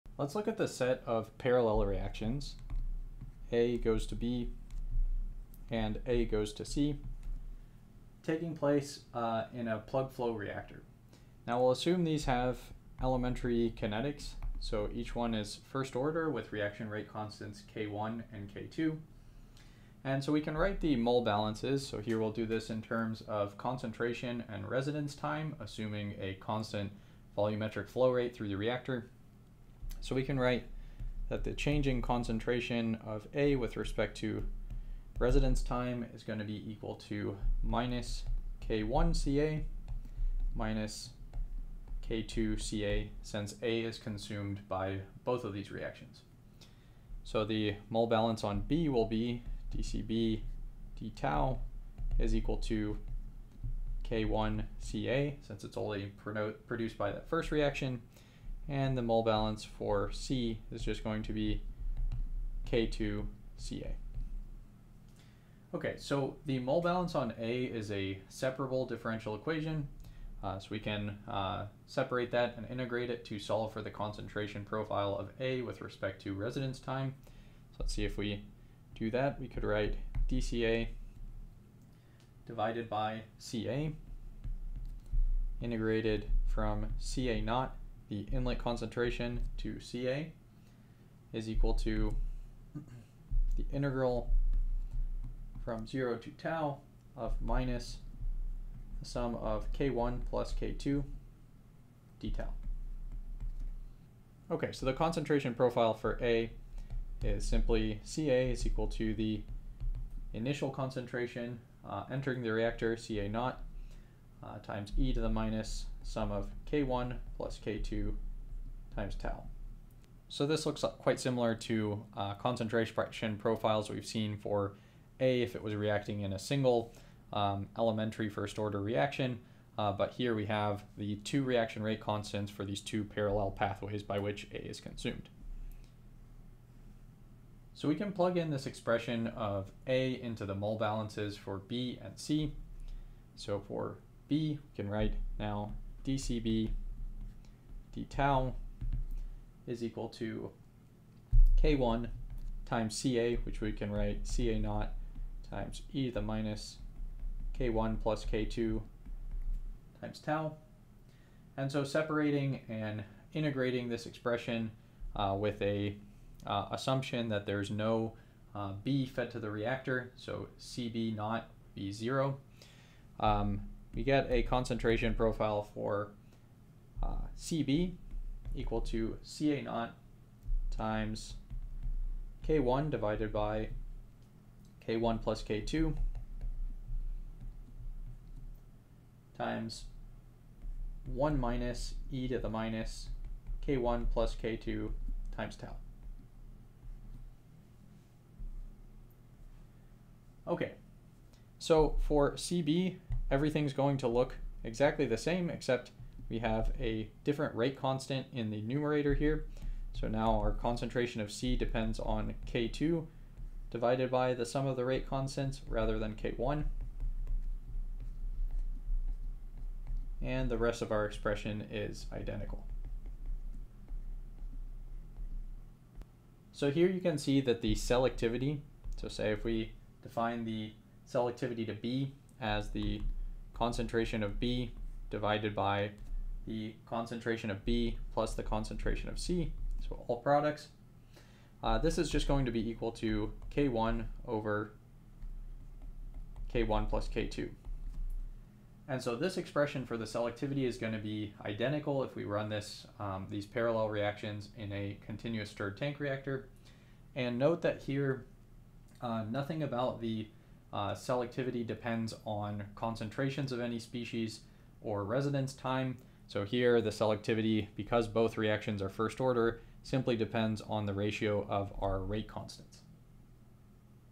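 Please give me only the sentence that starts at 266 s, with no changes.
So here the selectivity, because both reactions are first order, simply depends on the ratio of our rate constants.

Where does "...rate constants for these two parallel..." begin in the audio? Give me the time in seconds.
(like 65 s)
131 s.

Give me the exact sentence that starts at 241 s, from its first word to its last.
Uh, this is just going to be equal to K1 over K1 plus K2.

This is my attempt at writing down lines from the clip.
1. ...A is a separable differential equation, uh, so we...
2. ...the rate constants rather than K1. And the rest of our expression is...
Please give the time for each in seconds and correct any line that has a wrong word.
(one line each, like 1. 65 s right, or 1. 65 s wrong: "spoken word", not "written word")
1. 67 s right
2. 214 s right.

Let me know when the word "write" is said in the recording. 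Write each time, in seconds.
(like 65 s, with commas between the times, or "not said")
20 s, 30 s, 79 s, 144 s, 153 s.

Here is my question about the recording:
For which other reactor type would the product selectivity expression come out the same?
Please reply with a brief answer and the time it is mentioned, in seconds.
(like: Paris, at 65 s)
continuous stirred tank reactor, at 255 s.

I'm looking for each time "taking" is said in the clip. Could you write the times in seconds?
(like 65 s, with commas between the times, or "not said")
8 s.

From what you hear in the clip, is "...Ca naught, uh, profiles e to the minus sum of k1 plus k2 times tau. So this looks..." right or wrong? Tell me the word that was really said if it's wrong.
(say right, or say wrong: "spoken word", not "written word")
wrong: "times", not "profiles".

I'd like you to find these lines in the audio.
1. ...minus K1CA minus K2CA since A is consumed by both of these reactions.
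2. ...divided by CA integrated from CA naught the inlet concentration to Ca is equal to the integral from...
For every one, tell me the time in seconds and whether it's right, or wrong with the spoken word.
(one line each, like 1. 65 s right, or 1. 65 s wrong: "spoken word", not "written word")
1. 37 s right
2. 82 s right.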